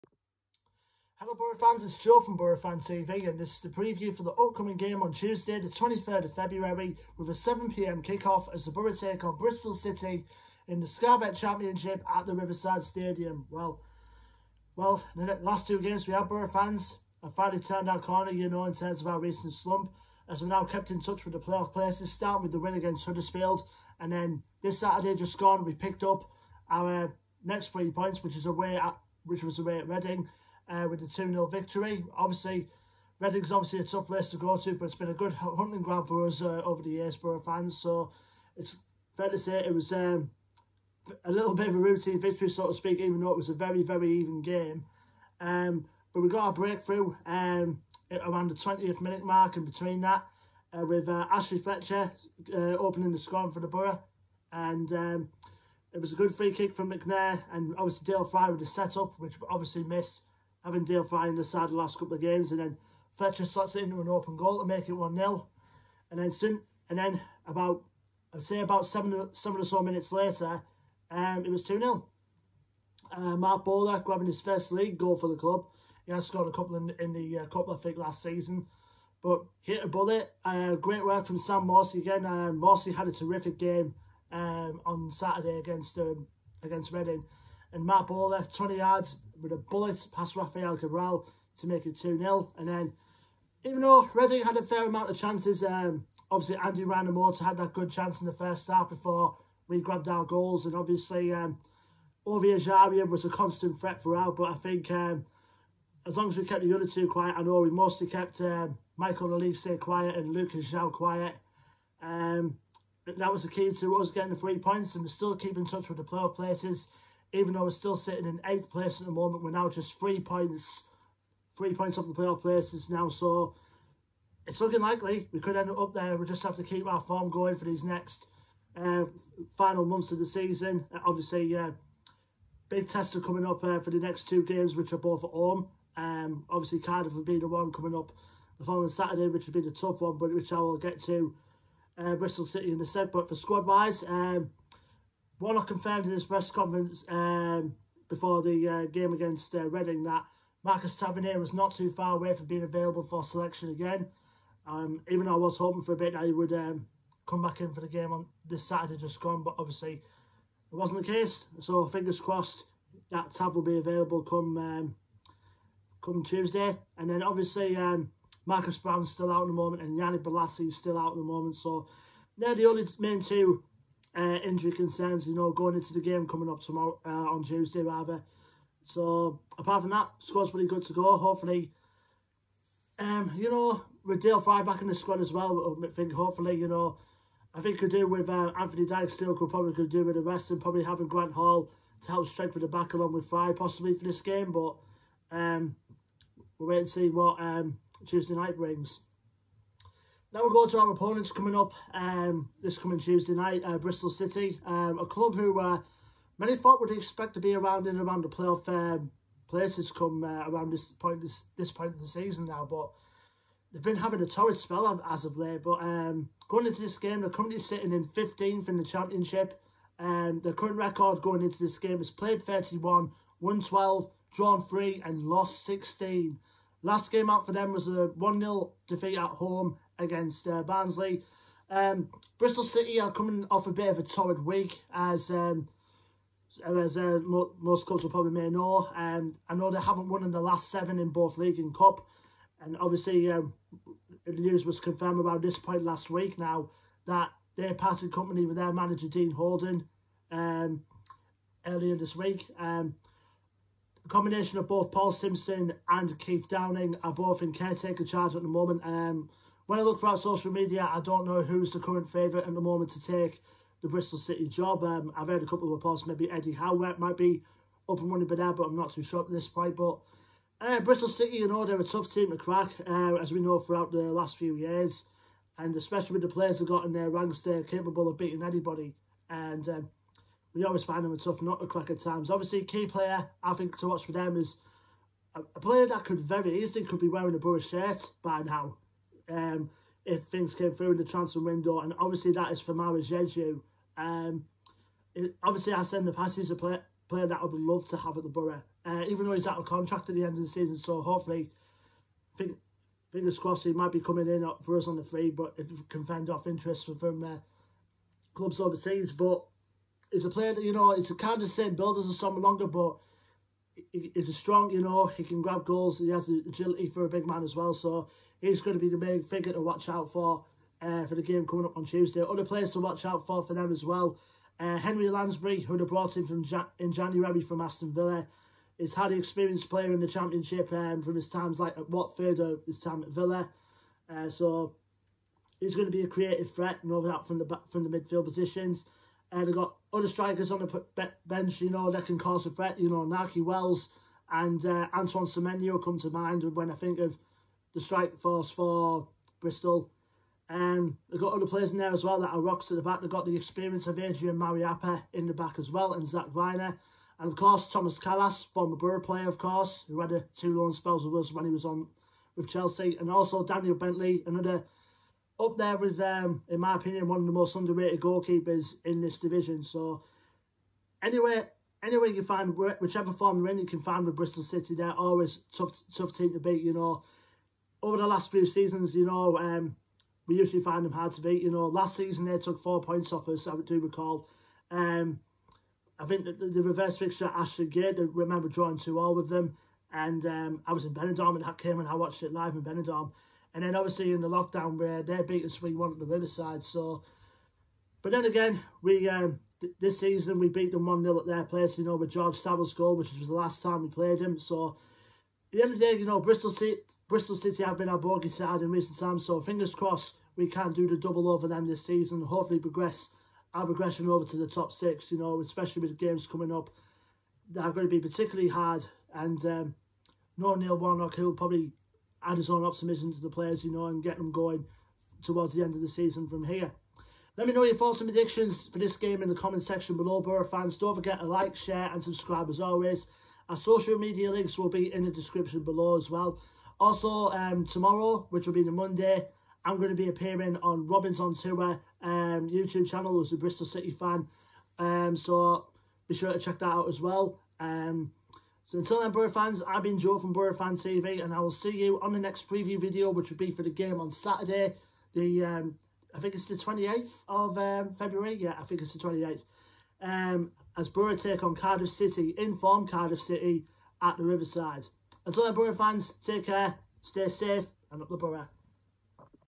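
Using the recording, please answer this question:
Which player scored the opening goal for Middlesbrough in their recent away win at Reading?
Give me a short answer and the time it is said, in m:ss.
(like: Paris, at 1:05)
Ashley Fletcher, at 0:51.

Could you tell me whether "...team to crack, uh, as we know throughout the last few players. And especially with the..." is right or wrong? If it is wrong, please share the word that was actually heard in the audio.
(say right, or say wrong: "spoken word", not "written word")
wrong: "years", not "players".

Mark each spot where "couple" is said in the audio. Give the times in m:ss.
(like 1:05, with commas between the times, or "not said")
1:01, 1:16, 4:25.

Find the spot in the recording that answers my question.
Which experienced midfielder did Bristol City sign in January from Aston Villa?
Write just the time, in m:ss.
5:24.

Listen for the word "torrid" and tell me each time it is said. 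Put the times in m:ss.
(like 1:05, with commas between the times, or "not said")
3:34, 3:54.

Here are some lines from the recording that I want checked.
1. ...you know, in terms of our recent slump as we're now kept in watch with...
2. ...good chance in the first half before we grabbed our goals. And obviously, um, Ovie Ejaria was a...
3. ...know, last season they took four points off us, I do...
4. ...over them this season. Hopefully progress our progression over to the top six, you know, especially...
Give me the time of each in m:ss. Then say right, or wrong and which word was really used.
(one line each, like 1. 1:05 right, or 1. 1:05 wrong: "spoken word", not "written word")
1. 0:18 wrong: "touch", not "watch"
2. 1:37 right
3. 6:21 right
4. 6:51 right.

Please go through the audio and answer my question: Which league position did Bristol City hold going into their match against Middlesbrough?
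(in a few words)
15th.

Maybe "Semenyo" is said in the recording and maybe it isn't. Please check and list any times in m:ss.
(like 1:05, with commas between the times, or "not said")
5:45.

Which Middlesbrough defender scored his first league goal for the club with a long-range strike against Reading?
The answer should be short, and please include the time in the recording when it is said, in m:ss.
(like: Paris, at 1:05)
Marc Bola, at 1:13.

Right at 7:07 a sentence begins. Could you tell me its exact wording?
Let me know your thoughts and predictions for this game in the comment section below, Boro fans.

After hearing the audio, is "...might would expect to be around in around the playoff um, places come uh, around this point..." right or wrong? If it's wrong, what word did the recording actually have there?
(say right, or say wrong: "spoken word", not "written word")
wrong: "thought", not "might".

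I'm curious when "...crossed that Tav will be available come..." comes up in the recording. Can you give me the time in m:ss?
2:42.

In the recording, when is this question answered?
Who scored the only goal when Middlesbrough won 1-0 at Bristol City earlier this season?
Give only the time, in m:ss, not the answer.
6:42.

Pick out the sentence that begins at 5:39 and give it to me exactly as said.
Uh, they've got other strikers on the bench, you know, that can cause a threat.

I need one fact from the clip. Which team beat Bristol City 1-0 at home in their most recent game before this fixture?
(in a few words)
Barnsley.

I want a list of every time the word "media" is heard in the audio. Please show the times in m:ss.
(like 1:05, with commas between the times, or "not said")
4:20, 7:13.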